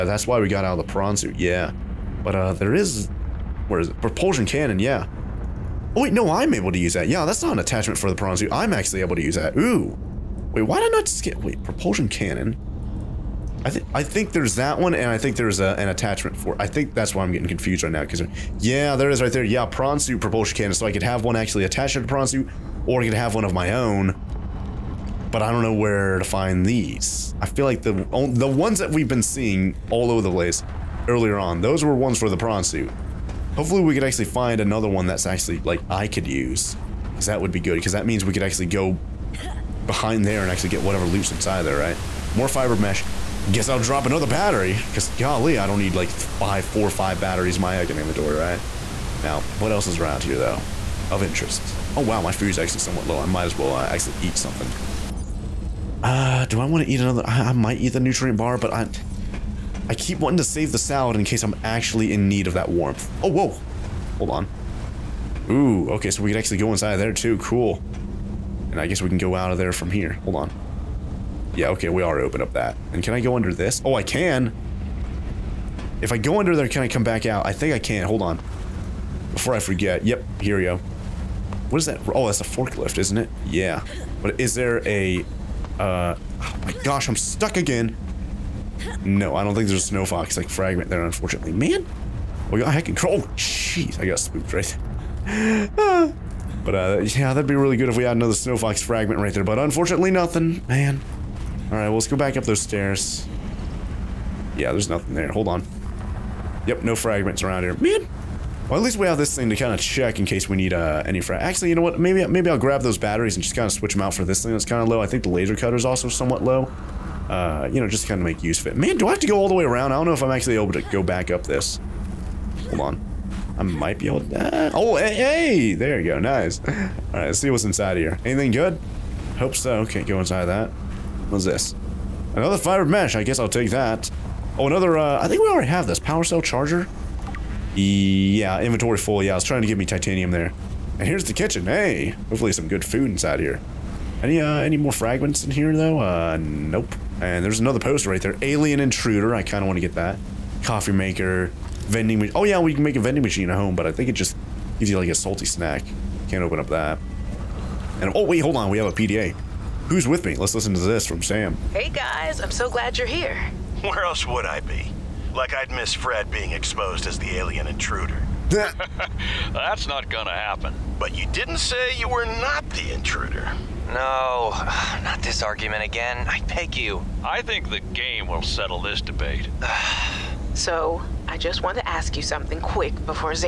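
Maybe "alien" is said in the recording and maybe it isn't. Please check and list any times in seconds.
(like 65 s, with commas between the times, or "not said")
148 s, 167 s.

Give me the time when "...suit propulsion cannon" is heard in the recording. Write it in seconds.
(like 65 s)
19 s.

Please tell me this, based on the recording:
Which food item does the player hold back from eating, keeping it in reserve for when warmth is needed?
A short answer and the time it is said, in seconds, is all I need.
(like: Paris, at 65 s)
The salad, at 60 s.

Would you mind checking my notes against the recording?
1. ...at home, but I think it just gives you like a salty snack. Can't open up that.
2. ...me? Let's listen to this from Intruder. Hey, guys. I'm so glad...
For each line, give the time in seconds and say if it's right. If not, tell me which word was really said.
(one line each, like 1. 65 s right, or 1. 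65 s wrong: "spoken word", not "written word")
1. 153 s right
2. 160 s wrong: "Sam", not "Intruder".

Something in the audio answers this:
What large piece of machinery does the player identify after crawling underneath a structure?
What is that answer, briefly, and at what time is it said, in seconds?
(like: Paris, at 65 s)
A forklift, at 82 s.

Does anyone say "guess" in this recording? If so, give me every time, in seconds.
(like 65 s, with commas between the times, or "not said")
43 s, 68 s, 133 s.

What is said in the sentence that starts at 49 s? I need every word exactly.
Now, what else is around here, though?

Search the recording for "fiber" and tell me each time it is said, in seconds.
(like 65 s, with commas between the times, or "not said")
42 s, 132 s.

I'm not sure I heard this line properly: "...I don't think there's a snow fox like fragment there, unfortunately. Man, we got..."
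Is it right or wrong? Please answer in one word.
right.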